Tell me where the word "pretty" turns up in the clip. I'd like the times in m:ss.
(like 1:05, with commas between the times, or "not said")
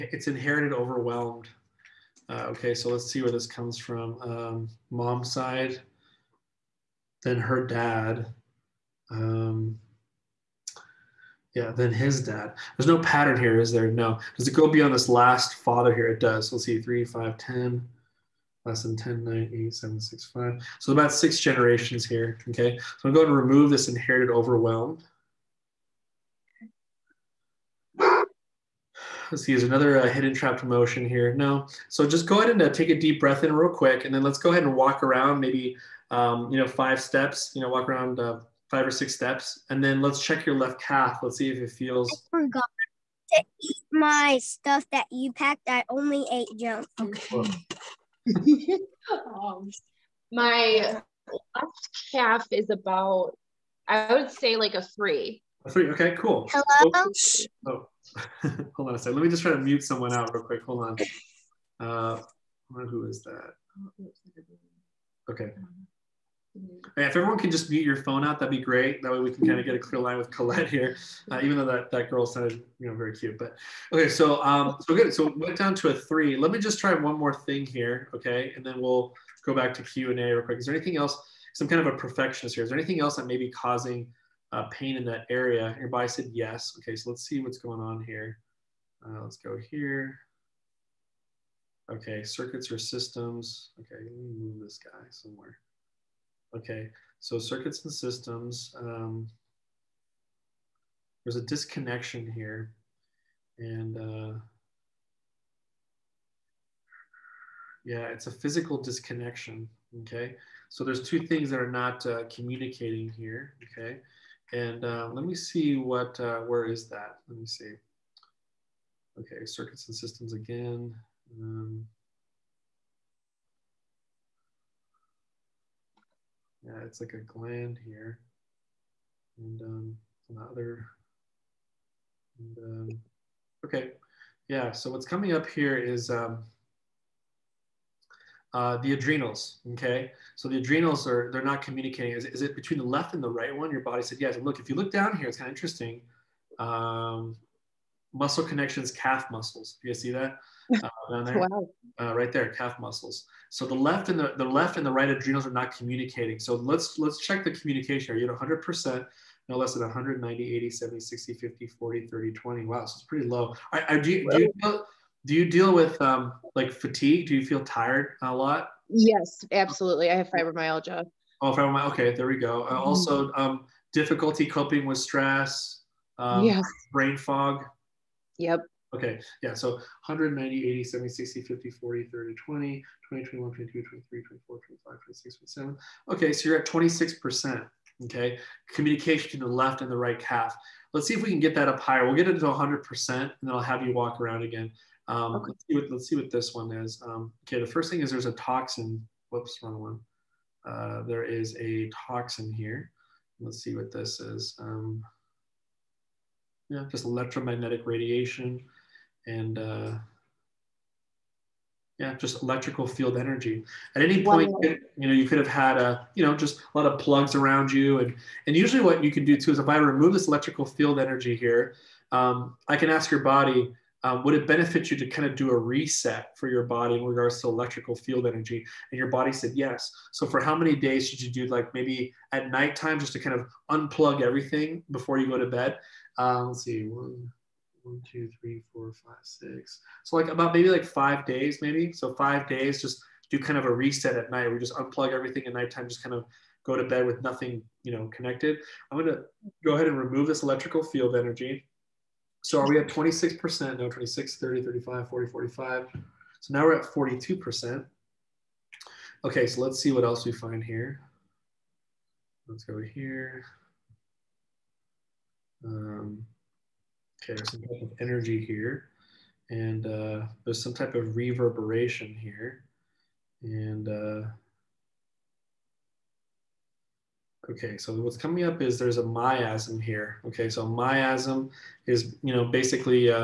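2:43.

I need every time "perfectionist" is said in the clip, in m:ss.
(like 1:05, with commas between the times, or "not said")
1:21.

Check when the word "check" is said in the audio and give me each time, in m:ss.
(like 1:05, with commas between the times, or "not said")
0:40, 2:37.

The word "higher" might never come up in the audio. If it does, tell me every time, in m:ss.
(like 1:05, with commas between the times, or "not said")
3:11.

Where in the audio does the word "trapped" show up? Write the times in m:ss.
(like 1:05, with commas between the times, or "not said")
0:30.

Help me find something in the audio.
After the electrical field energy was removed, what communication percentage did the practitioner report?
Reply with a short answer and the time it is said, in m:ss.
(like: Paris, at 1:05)
42%, at 4:16.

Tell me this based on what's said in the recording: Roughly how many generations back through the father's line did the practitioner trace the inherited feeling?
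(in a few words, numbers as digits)
6.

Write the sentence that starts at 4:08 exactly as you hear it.
I'm gonna go ahead and remove this electrical field energy.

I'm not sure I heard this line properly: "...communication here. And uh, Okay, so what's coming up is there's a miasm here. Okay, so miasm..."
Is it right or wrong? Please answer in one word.
wrong.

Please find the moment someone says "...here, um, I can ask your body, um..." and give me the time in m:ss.
3:41.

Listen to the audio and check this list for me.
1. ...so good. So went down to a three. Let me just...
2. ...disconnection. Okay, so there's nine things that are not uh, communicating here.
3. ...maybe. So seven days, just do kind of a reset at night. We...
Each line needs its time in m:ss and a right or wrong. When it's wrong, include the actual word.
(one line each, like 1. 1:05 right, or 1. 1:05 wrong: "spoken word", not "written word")
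1. 1:14 right
2. 1:48 wrong: "two", not "nine"
3. 4:01 wrong: "five", not "seven".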